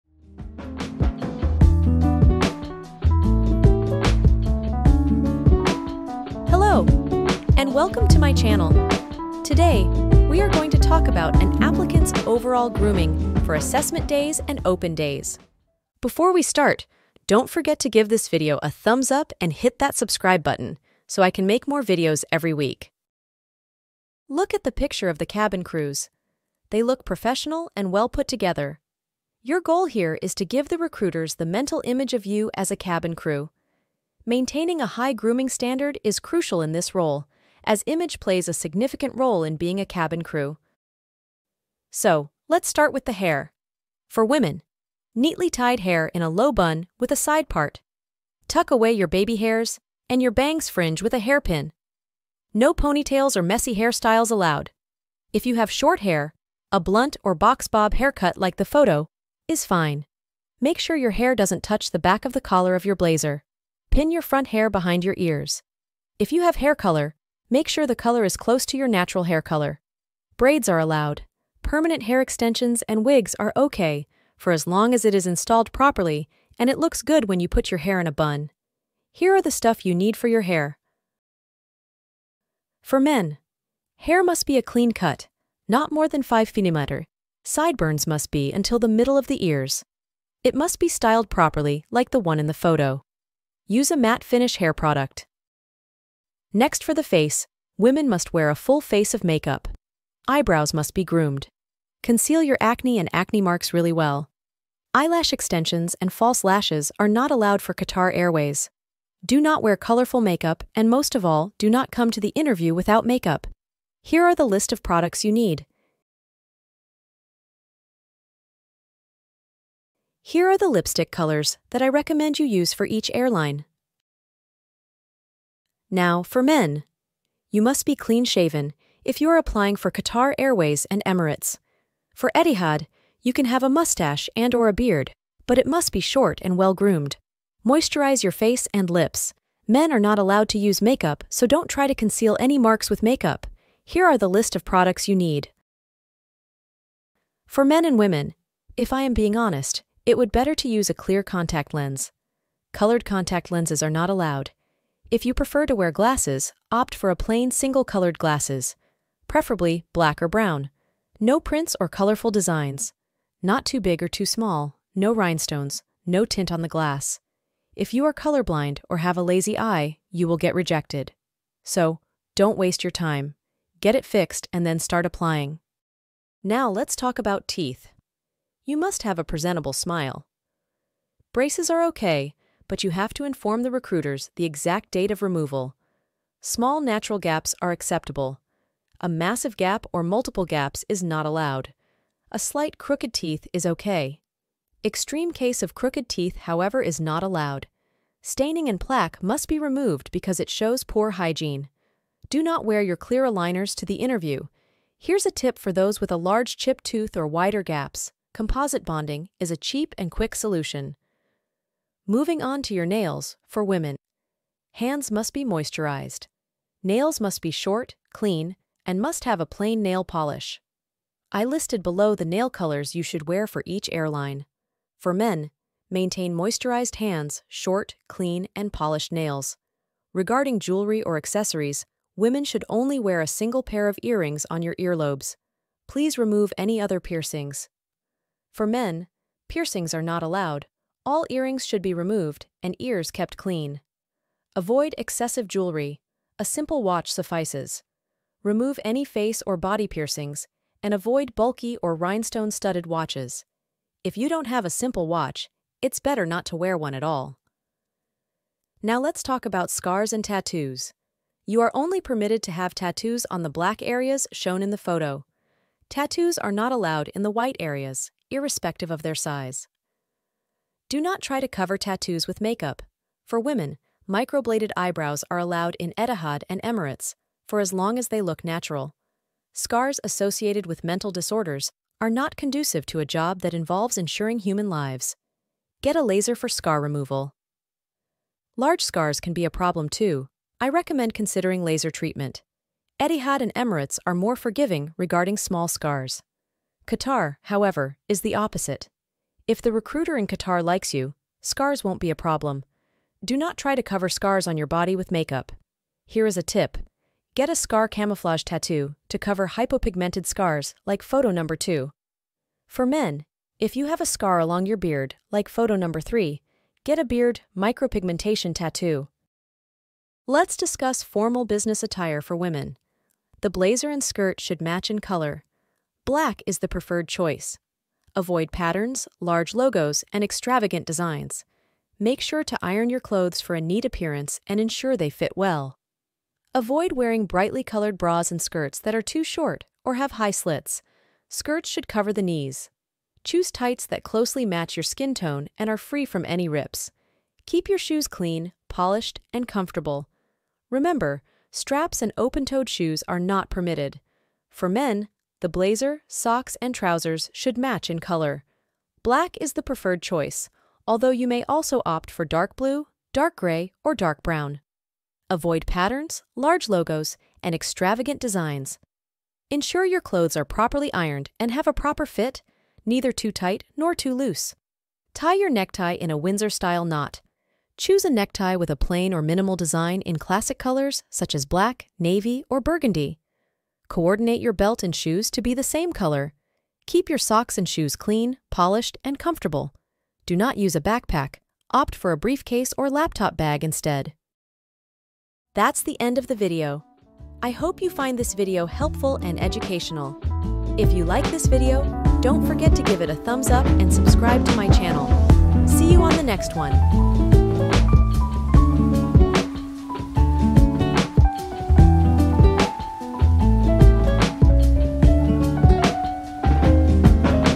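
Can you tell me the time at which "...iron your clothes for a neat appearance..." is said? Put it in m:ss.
5:32.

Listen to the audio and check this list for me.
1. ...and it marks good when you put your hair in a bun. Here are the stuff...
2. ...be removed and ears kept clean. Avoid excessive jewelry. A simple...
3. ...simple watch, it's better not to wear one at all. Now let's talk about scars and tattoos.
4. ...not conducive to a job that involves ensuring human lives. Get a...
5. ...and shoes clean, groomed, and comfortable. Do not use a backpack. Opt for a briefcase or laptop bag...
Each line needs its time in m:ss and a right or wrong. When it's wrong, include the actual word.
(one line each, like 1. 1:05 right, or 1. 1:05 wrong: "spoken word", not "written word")
1. 1:16 wrong: "looks", not "marks"
2. 4:01 right
3. 4:14 right
4. 4:42 right
5. 6:27 wrong: "polished", not "groomed".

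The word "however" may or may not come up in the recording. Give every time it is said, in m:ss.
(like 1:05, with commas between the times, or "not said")
3:16, 4:57.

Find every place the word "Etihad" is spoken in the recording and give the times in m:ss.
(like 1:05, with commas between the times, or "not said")
2:12, 4:35, 4:52.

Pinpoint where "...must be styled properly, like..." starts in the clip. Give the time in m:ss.
1:30.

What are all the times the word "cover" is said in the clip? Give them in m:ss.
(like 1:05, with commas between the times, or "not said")
4:31, 5:03, 5:09, 5:41.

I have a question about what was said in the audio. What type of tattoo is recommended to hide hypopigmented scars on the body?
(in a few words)
Scar camouflage tattoo.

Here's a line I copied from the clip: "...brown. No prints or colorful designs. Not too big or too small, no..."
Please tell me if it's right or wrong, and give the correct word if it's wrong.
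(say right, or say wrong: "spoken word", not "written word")
right.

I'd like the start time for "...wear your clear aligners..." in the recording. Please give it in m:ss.
3:22.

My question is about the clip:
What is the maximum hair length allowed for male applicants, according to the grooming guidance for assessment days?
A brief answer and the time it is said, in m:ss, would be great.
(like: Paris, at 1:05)
5 mm, at 1:26.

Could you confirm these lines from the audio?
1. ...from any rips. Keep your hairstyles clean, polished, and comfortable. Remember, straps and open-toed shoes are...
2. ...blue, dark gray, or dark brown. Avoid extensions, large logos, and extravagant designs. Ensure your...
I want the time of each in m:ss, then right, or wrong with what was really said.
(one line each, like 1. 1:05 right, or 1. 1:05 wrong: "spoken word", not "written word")
1. 5:46 wrong: "shoes", not "hairstyles"
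2. 6:02 wrong: "patterns", not "extensions".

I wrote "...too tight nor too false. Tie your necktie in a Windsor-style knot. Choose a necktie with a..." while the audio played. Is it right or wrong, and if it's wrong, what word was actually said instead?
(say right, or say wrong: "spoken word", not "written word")
wrong: "loose", not "false".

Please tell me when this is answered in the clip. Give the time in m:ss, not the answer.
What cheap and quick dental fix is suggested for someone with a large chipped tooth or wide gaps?
3:28.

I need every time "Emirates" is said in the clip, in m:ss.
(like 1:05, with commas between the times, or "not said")
2:11, 4:36, 4:53.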